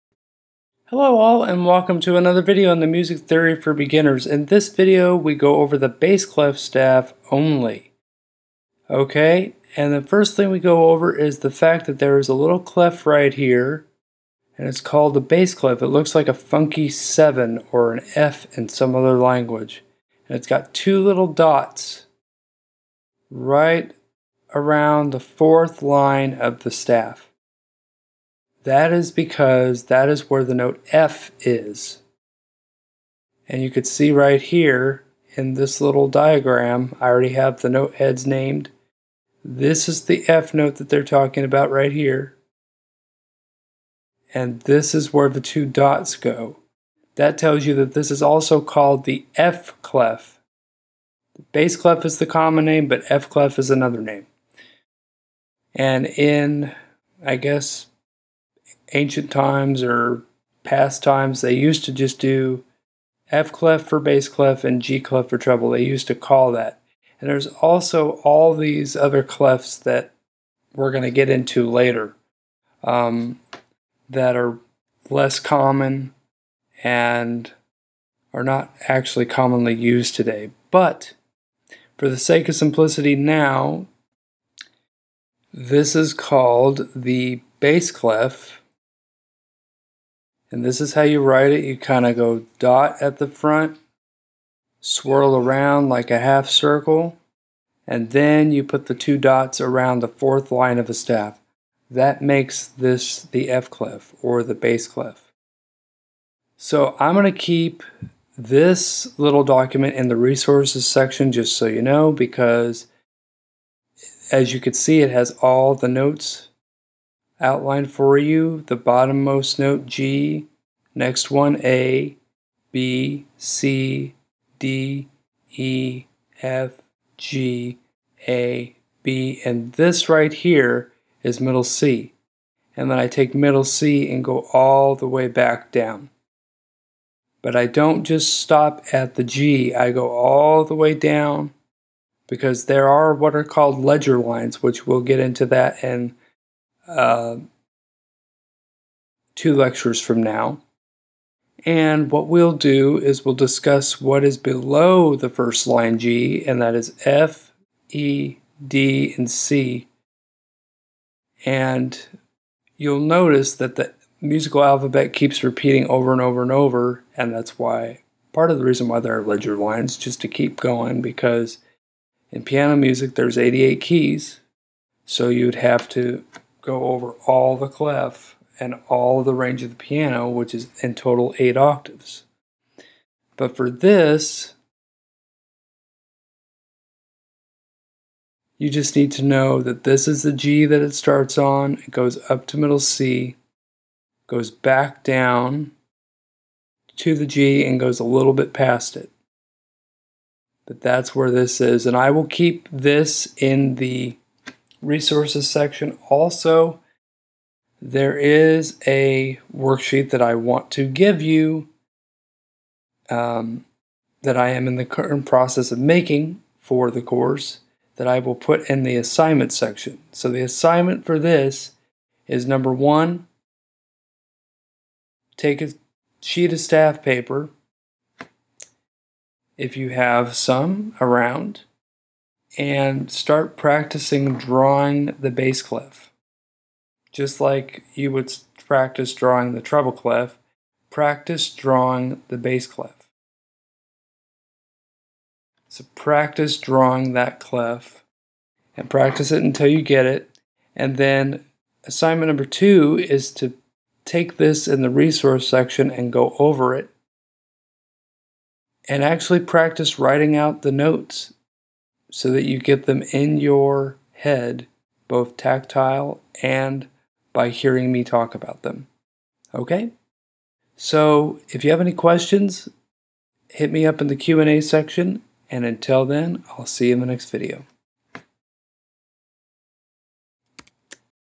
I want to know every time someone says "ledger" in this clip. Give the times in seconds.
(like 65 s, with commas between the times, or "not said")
143 s, 169 s.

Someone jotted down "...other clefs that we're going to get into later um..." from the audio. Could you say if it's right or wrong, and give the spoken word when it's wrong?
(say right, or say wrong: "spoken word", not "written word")
right.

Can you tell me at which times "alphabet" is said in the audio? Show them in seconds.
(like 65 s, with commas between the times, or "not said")
164 s.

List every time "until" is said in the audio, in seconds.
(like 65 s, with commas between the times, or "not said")
249 s, 275 s.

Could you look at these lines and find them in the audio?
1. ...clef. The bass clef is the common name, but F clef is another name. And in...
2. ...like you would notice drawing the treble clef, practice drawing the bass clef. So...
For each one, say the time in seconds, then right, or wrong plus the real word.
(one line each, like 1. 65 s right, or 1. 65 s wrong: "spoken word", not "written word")
1. 49 s right
2. 237 s wrong: "practice", not "notice".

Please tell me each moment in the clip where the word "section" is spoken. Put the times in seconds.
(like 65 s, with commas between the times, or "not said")
110 s, 205 s, 219 s, 255 s, 274 s.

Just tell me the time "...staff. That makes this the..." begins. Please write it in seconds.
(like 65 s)
100 s.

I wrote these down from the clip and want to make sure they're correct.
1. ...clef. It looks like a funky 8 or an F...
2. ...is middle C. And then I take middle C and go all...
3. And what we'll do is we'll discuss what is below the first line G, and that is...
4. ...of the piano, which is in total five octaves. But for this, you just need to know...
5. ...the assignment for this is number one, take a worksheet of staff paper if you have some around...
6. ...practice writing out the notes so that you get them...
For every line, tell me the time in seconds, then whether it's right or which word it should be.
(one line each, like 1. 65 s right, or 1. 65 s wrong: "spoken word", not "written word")
1. 15 s wrong: "7", not "8"
2. 131 s right
3. 151 s right
4. 179 s wrong: "eight", not "five"
5. 220 s wrong: "sheet", not "worksheet"
6. 259 s right.